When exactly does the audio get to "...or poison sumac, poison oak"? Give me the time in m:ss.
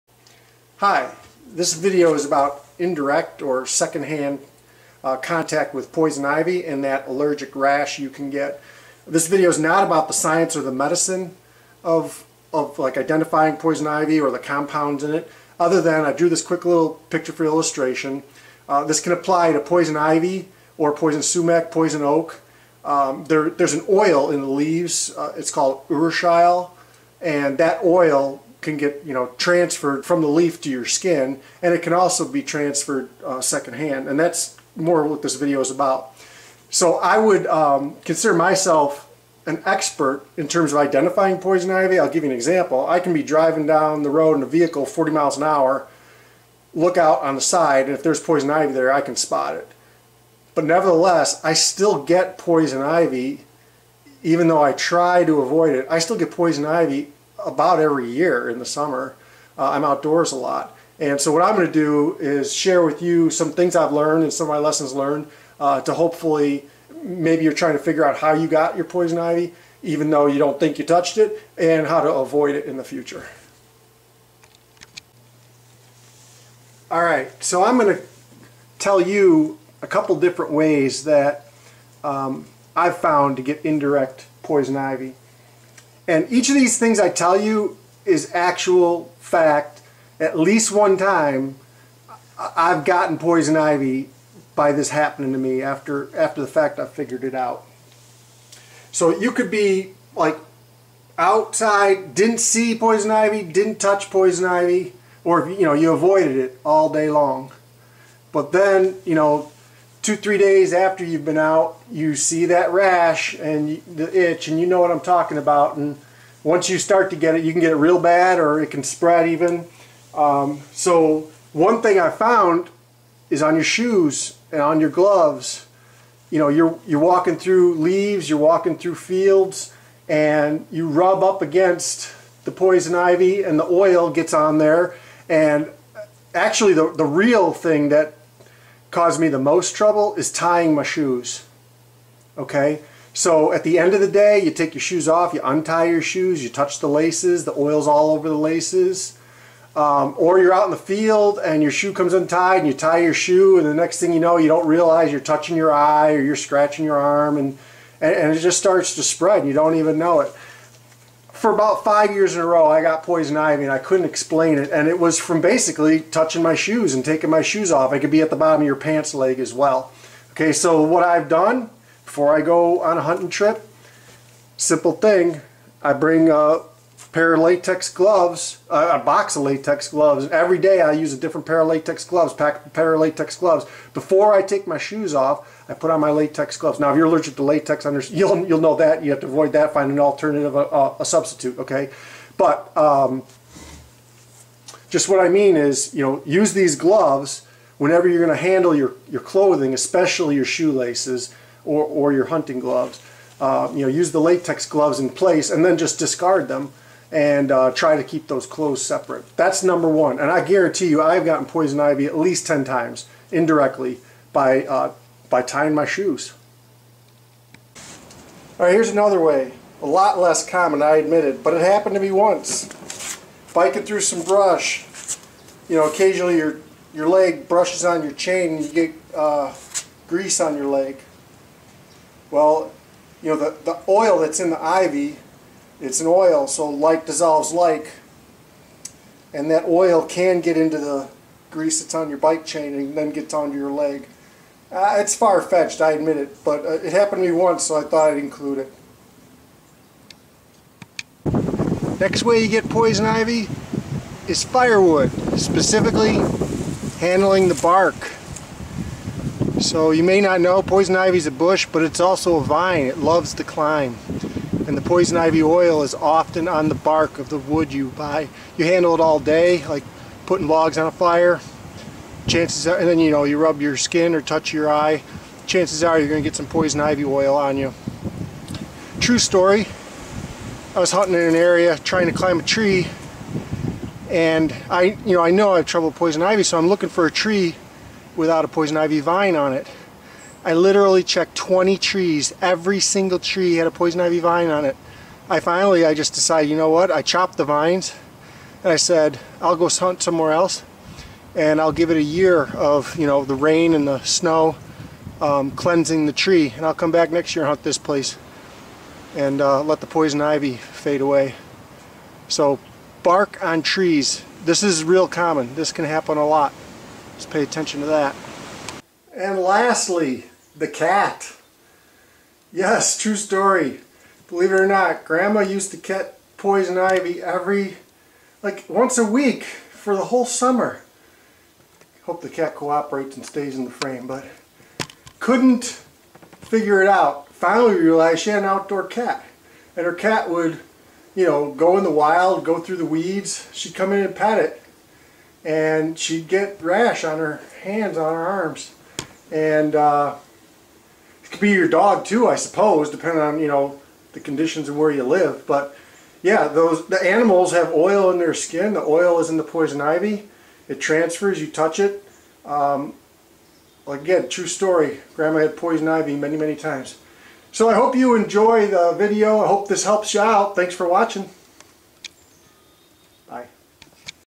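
0:20.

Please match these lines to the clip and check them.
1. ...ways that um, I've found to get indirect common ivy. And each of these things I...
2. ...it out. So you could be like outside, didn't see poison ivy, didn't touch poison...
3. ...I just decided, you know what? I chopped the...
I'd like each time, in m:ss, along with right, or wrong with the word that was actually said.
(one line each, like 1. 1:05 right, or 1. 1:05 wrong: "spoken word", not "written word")
1. 1:20 wrong: "poison", not "common"
2. 1:37 right
3. 4:55 right.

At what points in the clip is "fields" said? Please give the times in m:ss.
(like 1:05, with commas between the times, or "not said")
2:08, 2:30.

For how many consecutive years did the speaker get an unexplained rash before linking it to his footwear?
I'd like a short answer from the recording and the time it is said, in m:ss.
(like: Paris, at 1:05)
5, at 2:41.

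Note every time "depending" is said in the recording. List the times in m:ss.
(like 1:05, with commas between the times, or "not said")
5:52.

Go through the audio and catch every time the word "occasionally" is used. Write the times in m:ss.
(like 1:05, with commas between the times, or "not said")
3:45.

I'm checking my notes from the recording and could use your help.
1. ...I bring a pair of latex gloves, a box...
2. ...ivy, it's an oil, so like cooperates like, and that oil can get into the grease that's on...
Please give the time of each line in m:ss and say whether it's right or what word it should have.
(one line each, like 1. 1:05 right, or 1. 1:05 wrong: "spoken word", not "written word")
1. 2:55 right
2. 3:54 wrong: "dissolves", not "cooperates".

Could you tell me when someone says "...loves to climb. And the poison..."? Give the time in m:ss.
4:22.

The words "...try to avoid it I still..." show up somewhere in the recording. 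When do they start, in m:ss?
0:54.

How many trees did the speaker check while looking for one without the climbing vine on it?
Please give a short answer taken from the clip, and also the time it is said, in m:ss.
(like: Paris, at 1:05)
20, at 4:51.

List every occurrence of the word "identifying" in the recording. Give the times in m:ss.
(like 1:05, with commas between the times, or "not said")
0:12, 0:40.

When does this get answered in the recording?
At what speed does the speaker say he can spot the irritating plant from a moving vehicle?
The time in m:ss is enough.
0:44.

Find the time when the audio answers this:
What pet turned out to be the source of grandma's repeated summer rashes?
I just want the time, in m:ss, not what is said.
5:38.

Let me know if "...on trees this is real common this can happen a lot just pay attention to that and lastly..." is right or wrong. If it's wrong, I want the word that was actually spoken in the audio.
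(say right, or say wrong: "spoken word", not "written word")
right.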